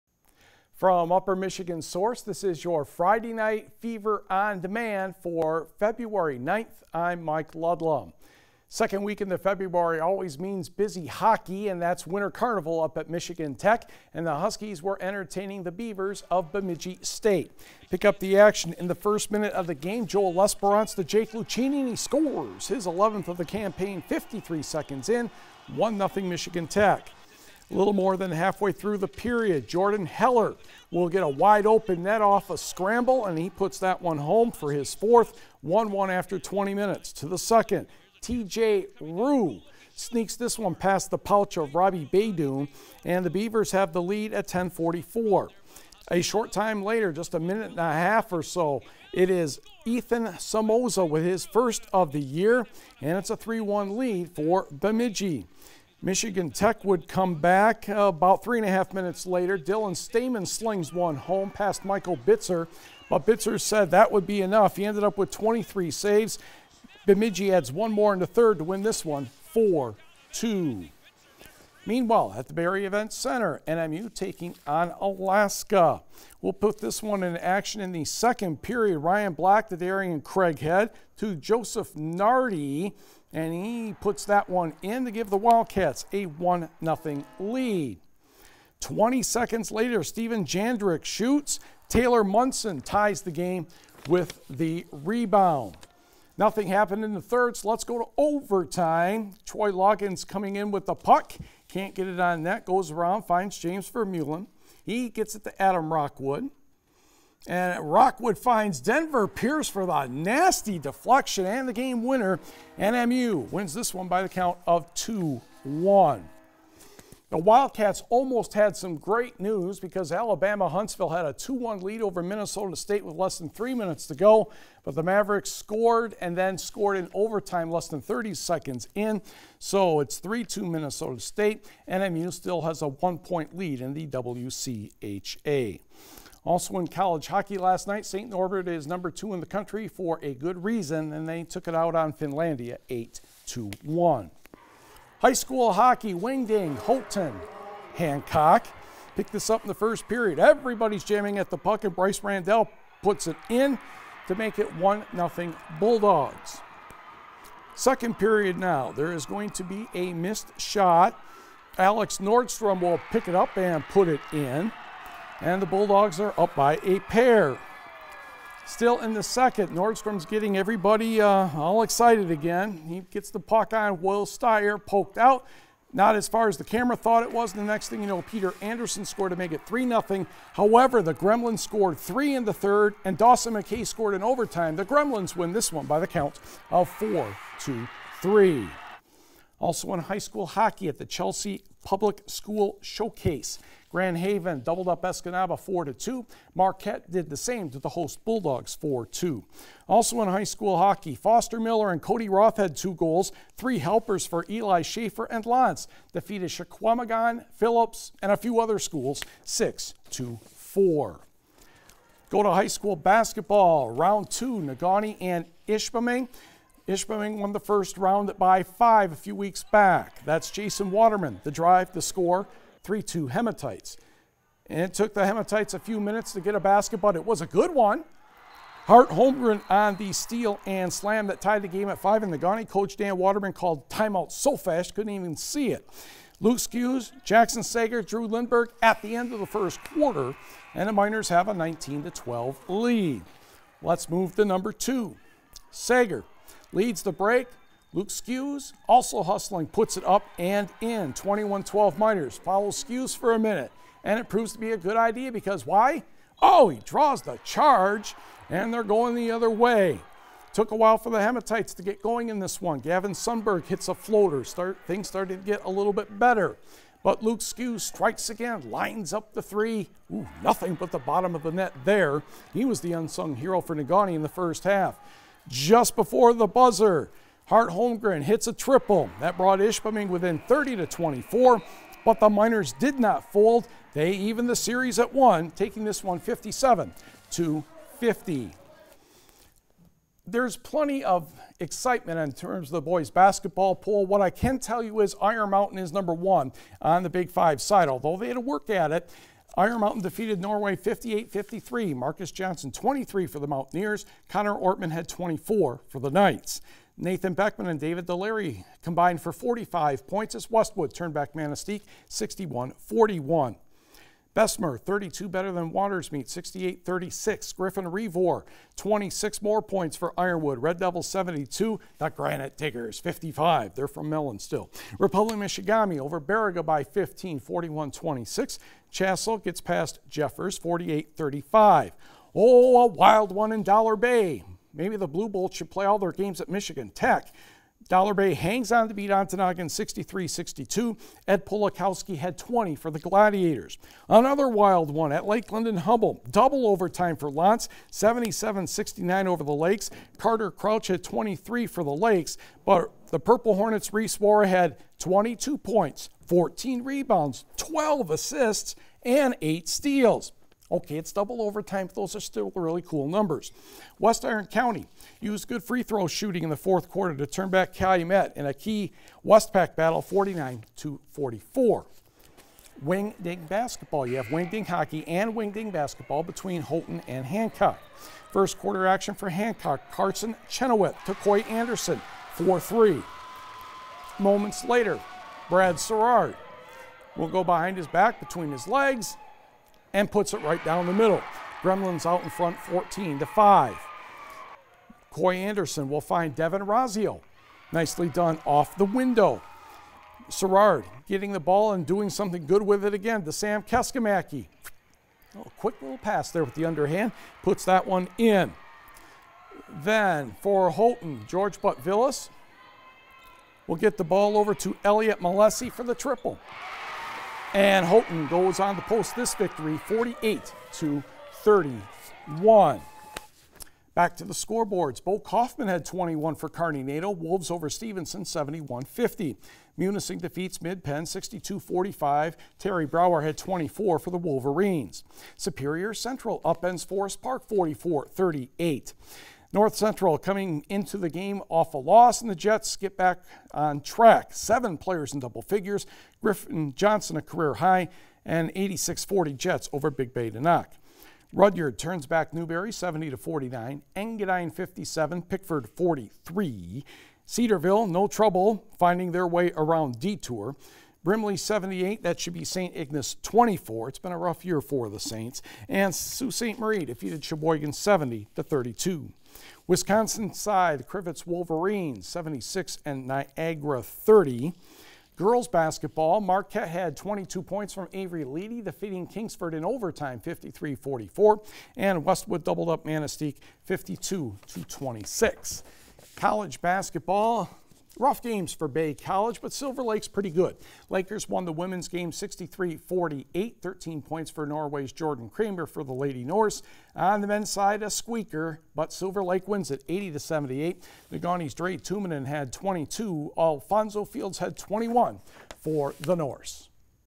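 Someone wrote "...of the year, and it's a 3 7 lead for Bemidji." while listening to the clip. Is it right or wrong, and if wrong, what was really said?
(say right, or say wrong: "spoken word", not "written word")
wrong: "1", not "7".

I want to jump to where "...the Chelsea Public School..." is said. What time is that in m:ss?
3:10.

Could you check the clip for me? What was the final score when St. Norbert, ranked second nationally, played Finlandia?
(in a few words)
8-1.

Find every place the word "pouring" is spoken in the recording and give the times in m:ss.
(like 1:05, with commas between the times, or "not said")
not said.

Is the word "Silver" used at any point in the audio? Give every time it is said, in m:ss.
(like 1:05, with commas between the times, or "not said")
8:09, 8:18.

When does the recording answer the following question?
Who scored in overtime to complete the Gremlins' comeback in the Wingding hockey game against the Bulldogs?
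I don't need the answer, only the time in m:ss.
3:03.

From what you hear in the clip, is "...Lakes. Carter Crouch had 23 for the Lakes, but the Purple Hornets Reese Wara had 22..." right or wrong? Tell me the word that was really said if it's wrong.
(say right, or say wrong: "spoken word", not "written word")
right.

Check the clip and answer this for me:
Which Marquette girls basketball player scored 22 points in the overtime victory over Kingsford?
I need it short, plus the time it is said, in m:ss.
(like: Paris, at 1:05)
Avery Leedy, at 7:57.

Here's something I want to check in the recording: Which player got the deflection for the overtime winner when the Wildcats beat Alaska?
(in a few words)
Denver Pierce.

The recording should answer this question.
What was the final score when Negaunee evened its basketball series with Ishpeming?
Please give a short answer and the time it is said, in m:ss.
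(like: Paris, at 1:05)
57-50, at 4:46.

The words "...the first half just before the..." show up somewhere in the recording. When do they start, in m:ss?
4:34.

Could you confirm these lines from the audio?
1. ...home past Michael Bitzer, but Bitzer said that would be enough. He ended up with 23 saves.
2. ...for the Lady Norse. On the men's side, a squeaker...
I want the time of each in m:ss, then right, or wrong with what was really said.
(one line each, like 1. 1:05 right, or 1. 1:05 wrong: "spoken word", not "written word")
1. 1:01 right
2. 8:15 right.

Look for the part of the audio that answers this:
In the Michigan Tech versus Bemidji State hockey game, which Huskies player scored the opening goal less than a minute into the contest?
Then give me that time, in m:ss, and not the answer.
0:21.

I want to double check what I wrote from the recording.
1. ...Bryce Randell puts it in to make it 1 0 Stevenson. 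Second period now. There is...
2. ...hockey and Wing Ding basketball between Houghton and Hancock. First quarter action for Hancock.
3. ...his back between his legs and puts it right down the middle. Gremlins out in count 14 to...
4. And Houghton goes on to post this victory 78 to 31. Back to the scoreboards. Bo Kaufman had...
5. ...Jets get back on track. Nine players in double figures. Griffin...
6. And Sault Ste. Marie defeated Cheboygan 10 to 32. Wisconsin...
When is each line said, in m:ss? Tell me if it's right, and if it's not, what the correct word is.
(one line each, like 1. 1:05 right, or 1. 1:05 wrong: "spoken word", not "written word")
1. 2:31 wrong: "Bulldogs", not "Stevenson"
2. 6:14 right
3. 6:27 wrong: "front", not "count"
4. 6:57 wrong: "48", not "78"
5. 7:22 wrong: "Seven", not "Nine"
6. 7:45 wrong: "70", not "10".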